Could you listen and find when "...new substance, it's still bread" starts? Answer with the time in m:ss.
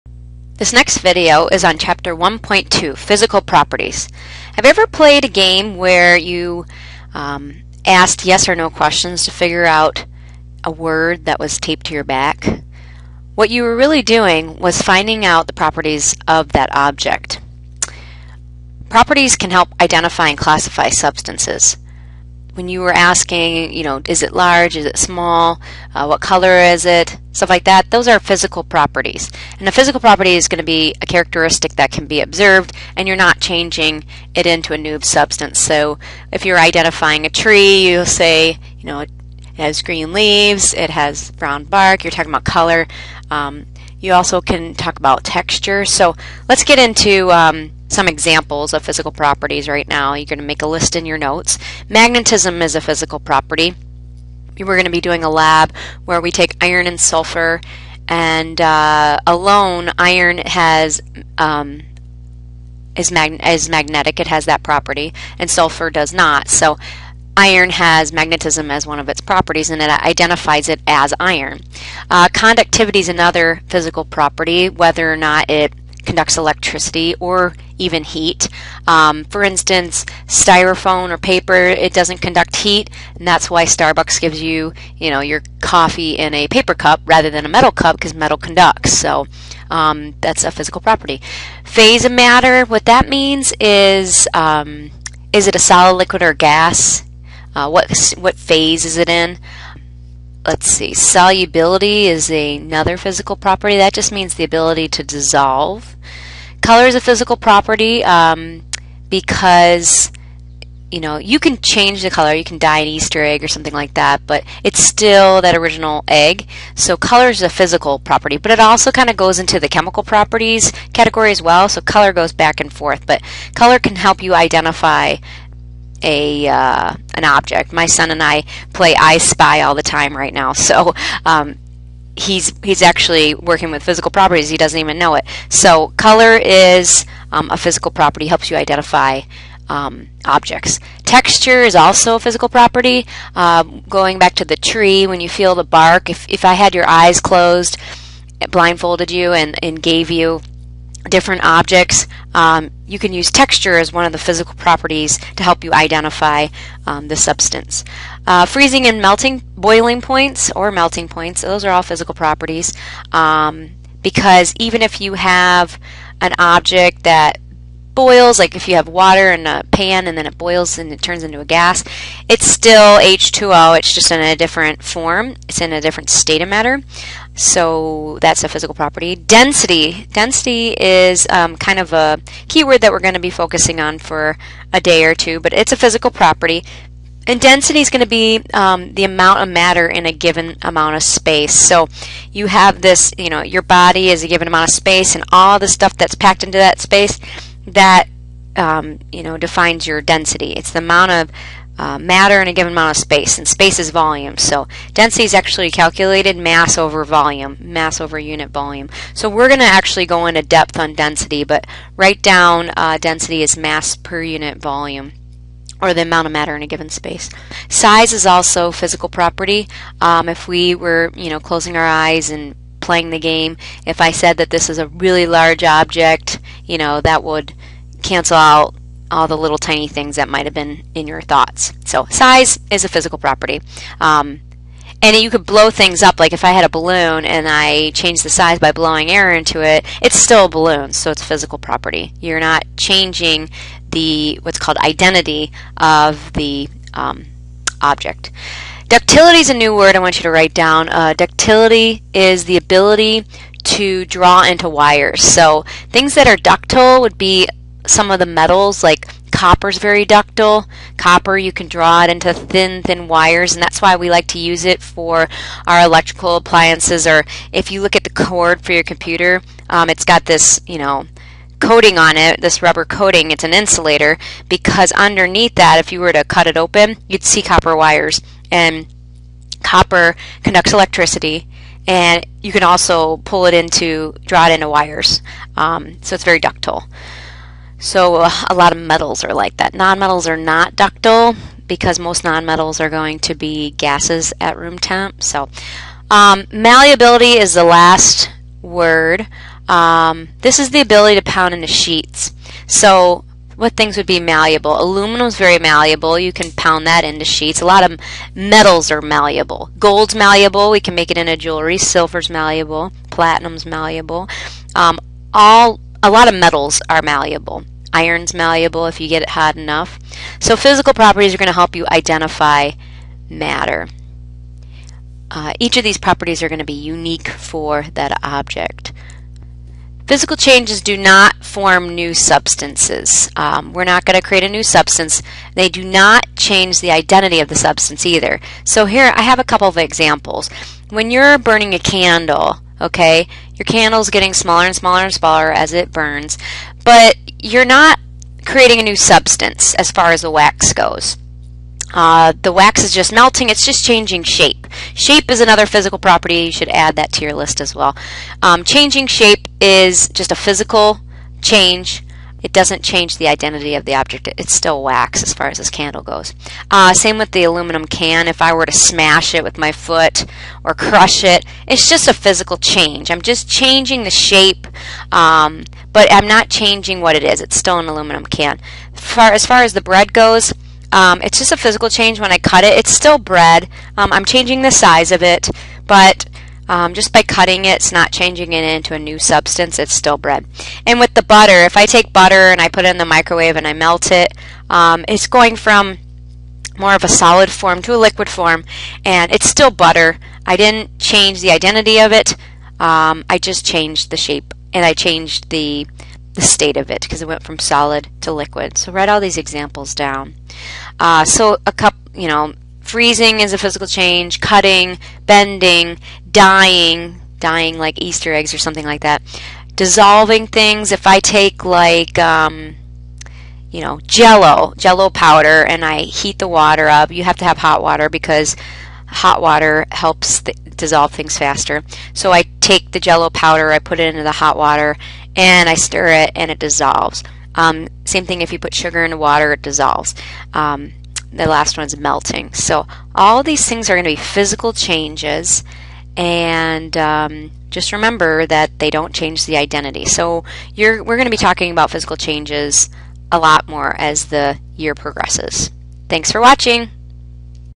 6:28.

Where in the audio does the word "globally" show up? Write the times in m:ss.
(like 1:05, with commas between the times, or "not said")
not said.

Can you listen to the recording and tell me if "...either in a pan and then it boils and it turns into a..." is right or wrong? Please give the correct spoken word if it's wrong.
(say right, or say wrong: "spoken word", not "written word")
wrong: "water", not "either".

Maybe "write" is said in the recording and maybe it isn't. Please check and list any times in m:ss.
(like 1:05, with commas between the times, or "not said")
3:31, 4:10, 6:48.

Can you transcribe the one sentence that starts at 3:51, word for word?
So size is a physical property.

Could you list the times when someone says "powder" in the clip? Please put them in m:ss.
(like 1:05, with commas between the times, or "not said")
7:05, 7:13.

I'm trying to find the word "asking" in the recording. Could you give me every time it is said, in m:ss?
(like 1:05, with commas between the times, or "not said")
0:22.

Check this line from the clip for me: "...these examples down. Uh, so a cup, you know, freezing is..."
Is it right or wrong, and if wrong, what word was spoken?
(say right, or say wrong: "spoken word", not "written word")
right.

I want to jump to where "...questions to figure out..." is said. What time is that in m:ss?
0:08.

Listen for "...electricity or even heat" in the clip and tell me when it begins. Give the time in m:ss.
1:16.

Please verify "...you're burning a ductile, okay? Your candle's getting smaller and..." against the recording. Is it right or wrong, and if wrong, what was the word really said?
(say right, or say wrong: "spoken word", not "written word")
wrong: "candle", not "ductile".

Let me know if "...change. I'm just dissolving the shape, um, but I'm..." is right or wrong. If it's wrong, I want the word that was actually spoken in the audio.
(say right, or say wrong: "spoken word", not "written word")
wrong: "changing", not "dissolving".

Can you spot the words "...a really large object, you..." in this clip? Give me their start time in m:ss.
3:44.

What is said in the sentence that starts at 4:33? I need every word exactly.
It's an insulator because underneath that, if you were to cut it open, you'd see copper wires.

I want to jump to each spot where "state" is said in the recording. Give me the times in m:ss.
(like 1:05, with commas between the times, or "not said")
2:56, 6:46.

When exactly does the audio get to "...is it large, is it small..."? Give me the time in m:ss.
0:24.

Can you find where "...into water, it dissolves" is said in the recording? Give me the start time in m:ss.
7:19.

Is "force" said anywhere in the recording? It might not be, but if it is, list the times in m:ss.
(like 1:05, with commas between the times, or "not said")
not said.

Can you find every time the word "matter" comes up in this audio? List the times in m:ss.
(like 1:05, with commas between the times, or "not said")
1:32, 2:56, 3:09, 3:21, 3:36, 5:23.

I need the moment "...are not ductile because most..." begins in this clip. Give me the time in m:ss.
4:50.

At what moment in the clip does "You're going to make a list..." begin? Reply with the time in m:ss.
0:50.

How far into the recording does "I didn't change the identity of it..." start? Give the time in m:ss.
6:40.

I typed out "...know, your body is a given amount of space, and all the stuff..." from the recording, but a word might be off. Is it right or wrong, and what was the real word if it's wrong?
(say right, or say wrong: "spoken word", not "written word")
right.